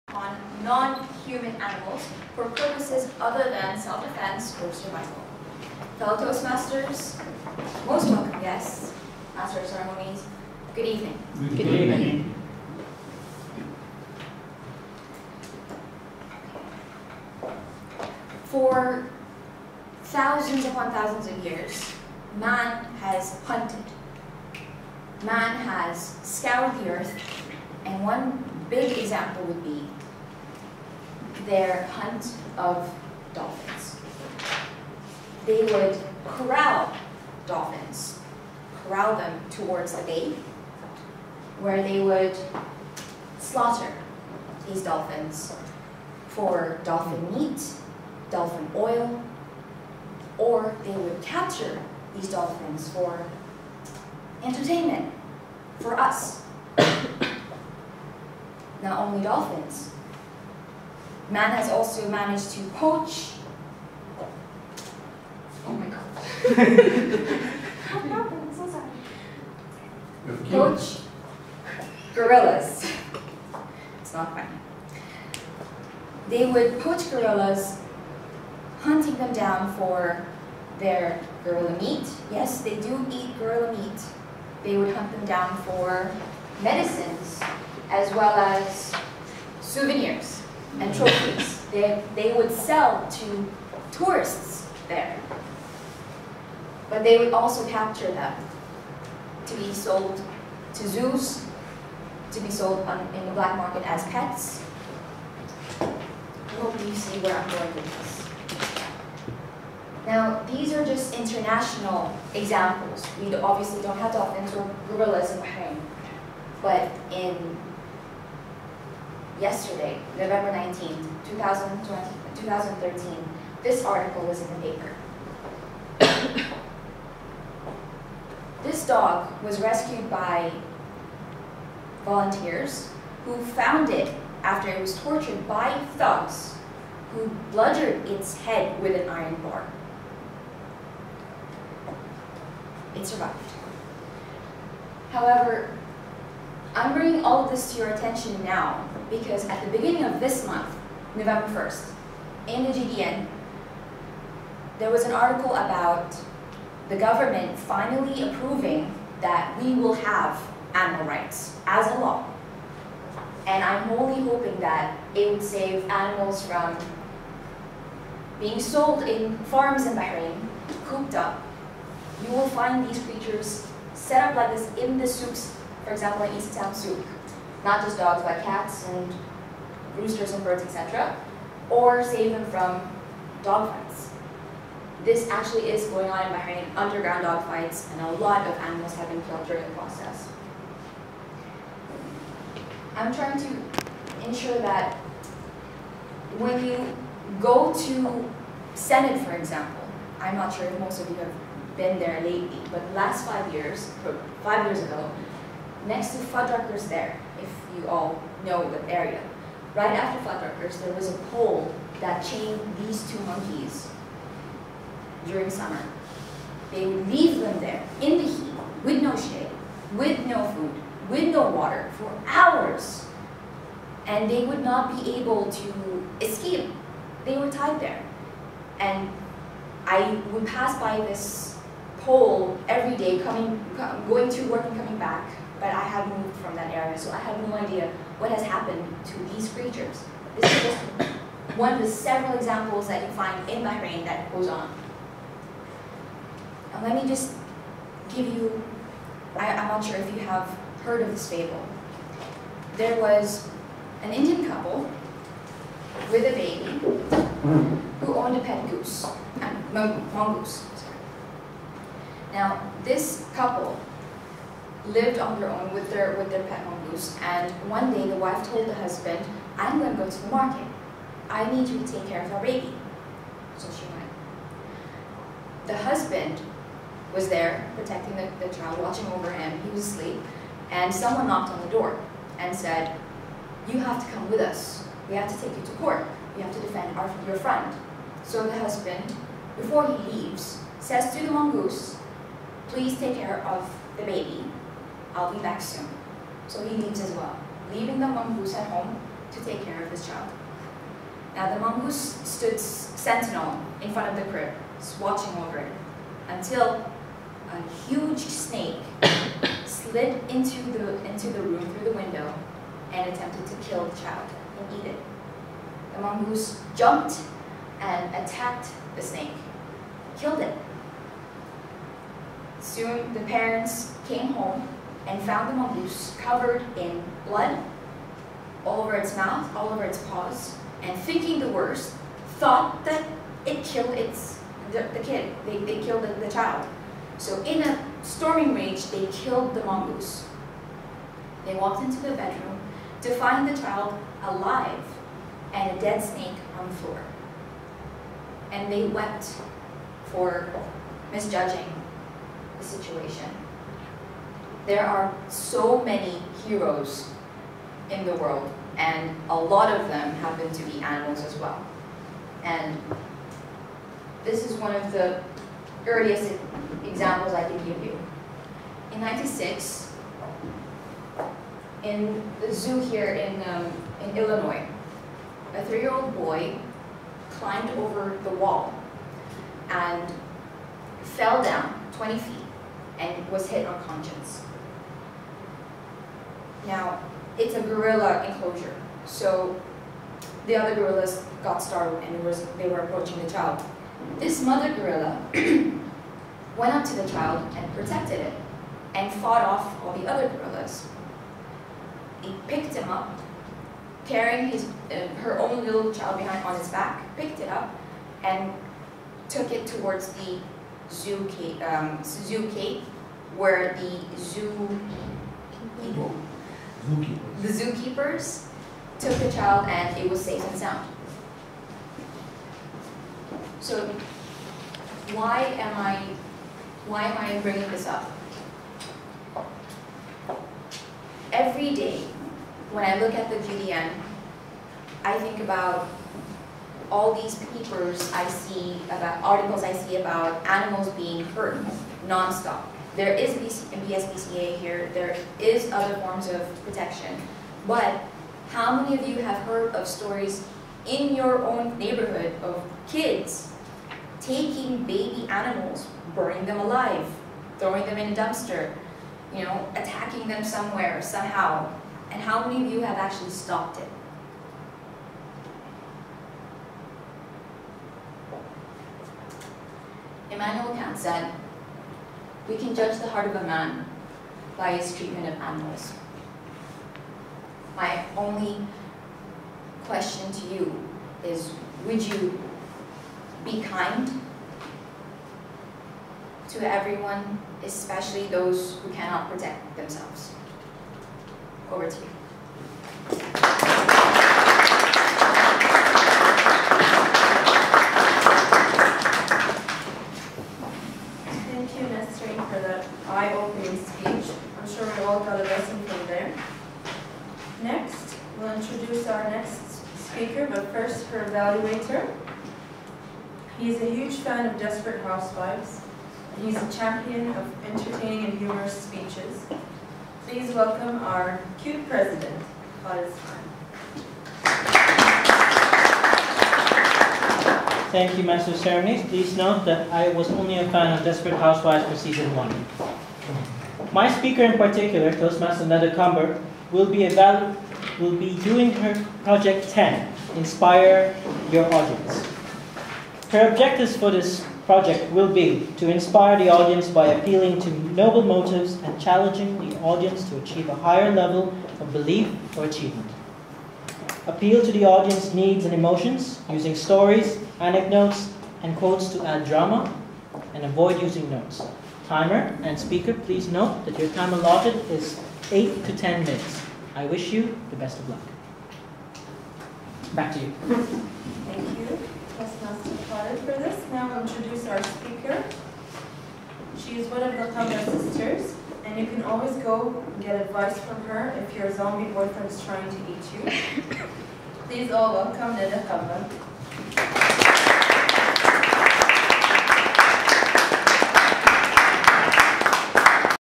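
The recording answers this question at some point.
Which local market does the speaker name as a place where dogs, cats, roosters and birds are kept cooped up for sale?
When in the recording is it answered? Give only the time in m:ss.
2:56.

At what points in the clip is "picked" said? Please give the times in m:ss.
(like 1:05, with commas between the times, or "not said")
6:42, 6:47.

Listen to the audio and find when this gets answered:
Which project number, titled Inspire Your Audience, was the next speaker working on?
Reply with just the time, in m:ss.
8:59.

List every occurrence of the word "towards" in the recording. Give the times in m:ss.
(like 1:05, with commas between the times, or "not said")
0:39, 6:49.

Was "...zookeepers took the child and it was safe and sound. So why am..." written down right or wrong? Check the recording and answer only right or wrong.
right.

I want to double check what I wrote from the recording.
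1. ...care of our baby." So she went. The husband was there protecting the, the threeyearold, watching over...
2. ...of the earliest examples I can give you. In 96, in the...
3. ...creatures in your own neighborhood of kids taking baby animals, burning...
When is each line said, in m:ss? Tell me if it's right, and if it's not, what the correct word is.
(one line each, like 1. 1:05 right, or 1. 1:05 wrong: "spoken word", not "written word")
1. 4:32 wrong: "child", not "threeyearold"
2. 6:04 right
3. 7:29 wrong: "stories", not "creatures".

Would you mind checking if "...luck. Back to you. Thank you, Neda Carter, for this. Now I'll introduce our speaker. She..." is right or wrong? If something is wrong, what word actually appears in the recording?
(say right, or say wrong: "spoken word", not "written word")
wrong: "Postmaster", not "Neda".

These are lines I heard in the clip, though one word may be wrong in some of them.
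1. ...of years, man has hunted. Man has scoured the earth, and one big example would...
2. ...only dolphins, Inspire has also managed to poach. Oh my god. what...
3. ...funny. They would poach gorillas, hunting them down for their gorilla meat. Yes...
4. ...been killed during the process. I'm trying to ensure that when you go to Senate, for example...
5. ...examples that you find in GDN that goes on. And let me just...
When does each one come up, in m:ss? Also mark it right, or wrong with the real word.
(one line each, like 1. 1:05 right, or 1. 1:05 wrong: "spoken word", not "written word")
1. 0:21 right
2. 0:58 wrong: "Man", not "Inspire"
3. 1:14 right
4. 3:09 right
5. 4:02 wrong: "Bahrain", not "GDN".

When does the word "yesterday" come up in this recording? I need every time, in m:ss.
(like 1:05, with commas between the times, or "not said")
1:59.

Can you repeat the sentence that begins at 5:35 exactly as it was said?
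They, they killed the, the child.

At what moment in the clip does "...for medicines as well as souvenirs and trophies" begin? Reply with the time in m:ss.
1:25.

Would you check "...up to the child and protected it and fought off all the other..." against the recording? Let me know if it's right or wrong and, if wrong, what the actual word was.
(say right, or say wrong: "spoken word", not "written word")
right.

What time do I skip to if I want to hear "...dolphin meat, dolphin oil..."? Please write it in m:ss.
0:46.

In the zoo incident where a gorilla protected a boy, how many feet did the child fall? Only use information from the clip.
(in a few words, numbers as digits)
20.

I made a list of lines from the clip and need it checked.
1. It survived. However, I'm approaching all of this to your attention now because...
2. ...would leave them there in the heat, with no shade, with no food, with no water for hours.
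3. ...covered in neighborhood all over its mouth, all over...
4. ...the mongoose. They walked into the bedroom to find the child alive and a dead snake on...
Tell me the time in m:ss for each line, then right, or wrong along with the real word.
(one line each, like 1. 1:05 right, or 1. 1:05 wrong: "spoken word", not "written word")
1. 2:22 wrong: "bringing", not "approaching"
2. 3:36 right
3. 5:26 wrong: "blood", not "neighborhood"
4. 5:39 right.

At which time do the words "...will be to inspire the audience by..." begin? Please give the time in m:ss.
9:05.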